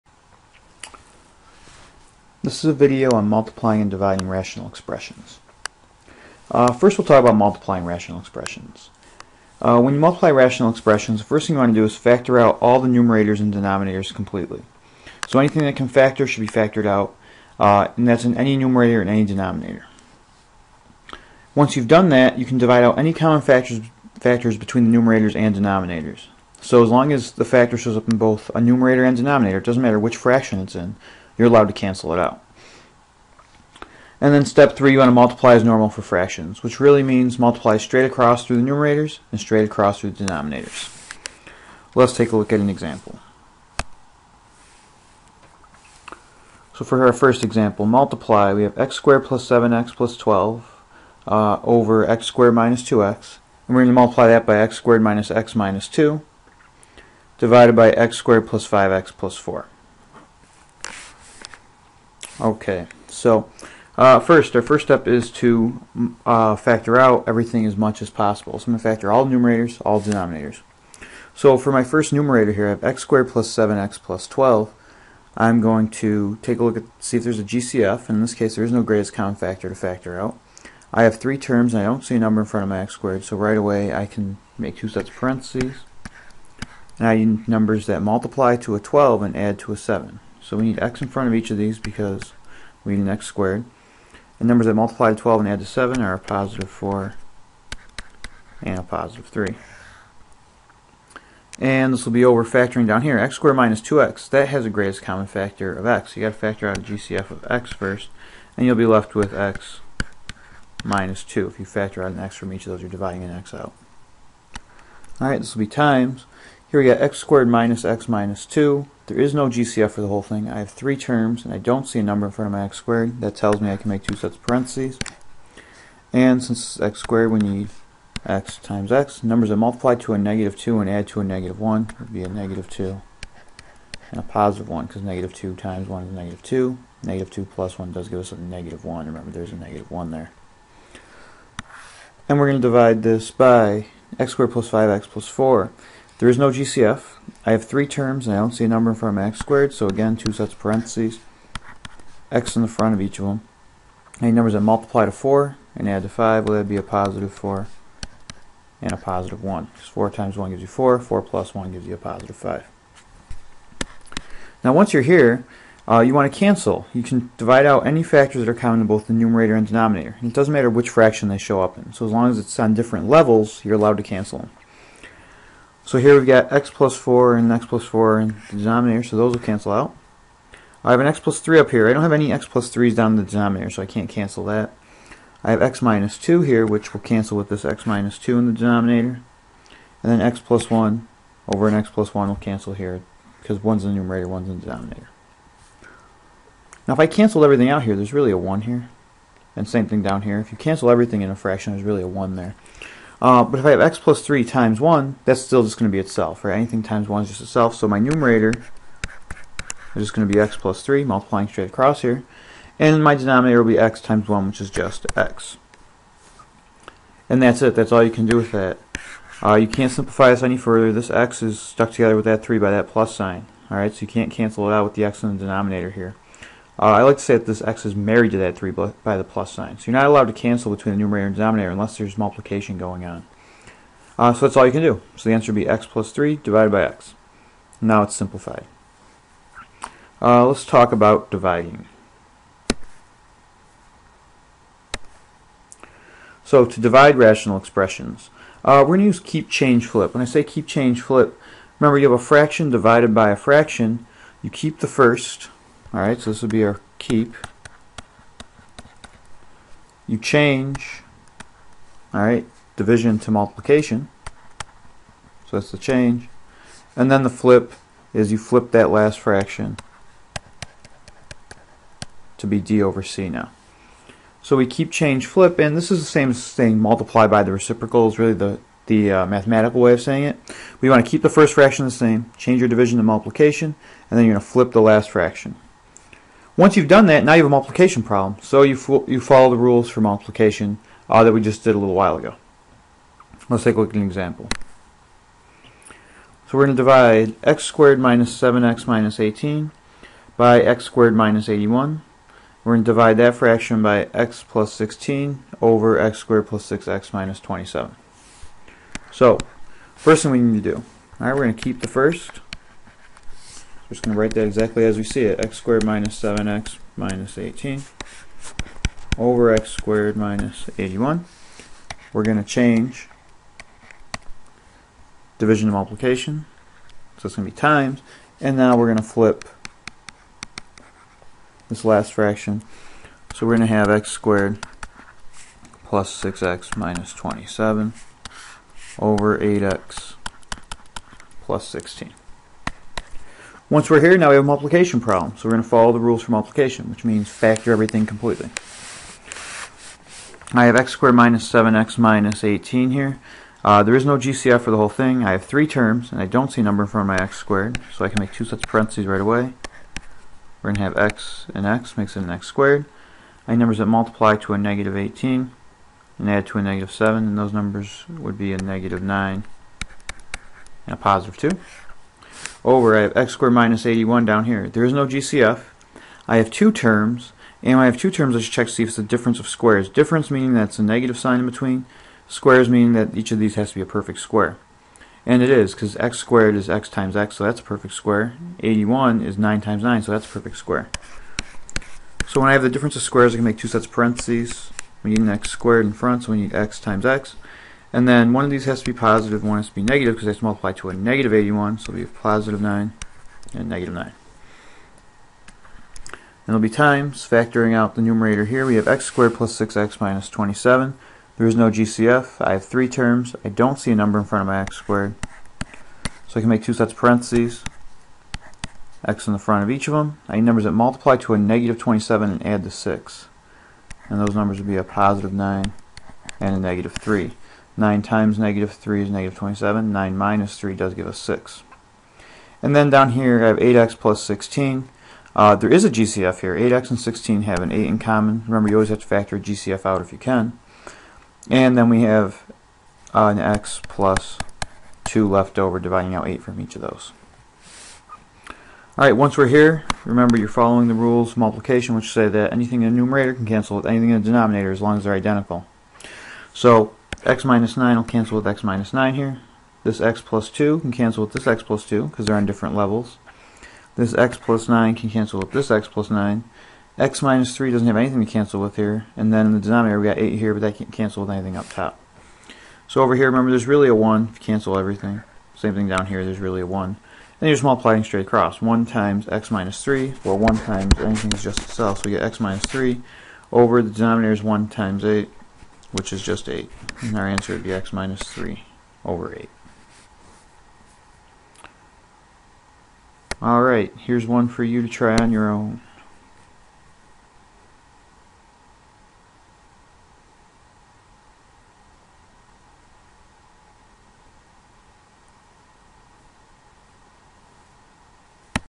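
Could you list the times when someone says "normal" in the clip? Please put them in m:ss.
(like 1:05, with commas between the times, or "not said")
0:35.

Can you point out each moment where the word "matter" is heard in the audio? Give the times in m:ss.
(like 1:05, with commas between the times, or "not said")
0:29, 2:50.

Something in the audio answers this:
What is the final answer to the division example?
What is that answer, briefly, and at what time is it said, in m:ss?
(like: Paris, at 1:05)
(x-3)/8, at 8:07.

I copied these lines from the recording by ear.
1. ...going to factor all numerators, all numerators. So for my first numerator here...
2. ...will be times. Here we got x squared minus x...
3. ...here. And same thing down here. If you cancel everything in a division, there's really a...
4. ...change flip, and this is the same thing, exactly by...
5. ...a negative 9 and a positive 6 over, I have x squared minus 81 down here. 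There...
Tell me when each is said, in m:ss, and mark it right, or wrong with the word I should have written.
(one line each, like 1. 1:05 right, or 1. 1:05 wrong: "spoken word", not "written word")
1. 1:08 wrong: "denominators", not "numerators"
2. 1:55 right
3. 3:18 wrong: "fraction", not "division"
4. 4:34 wrong: "multiply", not "exactly"
5. 6:08 wrong: "2", not "6".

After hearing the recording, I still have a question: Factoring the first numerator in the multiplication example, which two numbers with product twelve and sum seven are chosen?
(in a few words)
4 and 3.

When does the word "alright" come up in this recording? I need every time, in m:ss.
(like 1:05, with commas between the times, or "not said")
1:55, 3:43, 4:15, 4:22, 7:28, 8:13.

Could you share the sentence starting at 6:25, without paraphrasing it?
And it is, because x squared is x times x, so that's a perfect square.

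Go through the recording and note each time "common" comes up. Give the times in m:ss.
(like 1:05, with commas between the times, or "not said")
0:23, 1:19, 1:45, 2:48, 7:17.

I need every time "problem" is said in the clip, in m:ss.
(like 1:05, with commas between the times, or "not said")
4:48, 5:44.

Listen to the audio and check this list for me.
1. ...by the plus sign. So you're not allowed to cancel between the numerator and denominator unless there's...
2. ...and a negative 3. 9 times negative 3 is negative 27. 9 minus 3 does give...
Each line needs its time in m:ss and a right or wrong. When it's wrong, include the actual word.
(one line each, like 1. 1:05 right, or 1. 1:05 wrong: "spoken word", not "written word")
1. 3:48 right
2. 7:06 right.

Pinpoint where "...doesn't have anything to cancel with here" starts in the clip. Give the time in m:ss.
7:47.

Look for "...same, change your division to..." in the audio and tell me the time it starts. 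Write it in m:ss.
4:41.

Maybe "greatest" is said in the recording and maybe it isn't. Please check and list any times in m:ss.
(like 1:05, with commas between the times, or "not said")
1:18, 1:44.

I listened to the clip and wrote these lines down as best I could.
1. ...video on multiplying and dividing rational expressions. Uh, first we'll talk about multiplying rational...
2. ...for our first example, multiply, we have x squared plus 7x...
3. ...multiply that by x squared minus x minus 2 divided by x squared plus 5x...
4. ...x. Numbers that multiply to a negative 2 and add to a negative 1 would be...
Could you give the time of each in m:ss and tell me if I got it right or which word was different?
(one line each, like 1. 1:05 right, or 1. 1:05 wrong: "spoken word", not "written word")
1. 0:02 right
2. 0:46 right
3. 0:53 right
4. 2:08 right.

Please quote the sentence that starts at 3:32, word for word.
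And my denominator will be x times 1, which is just x.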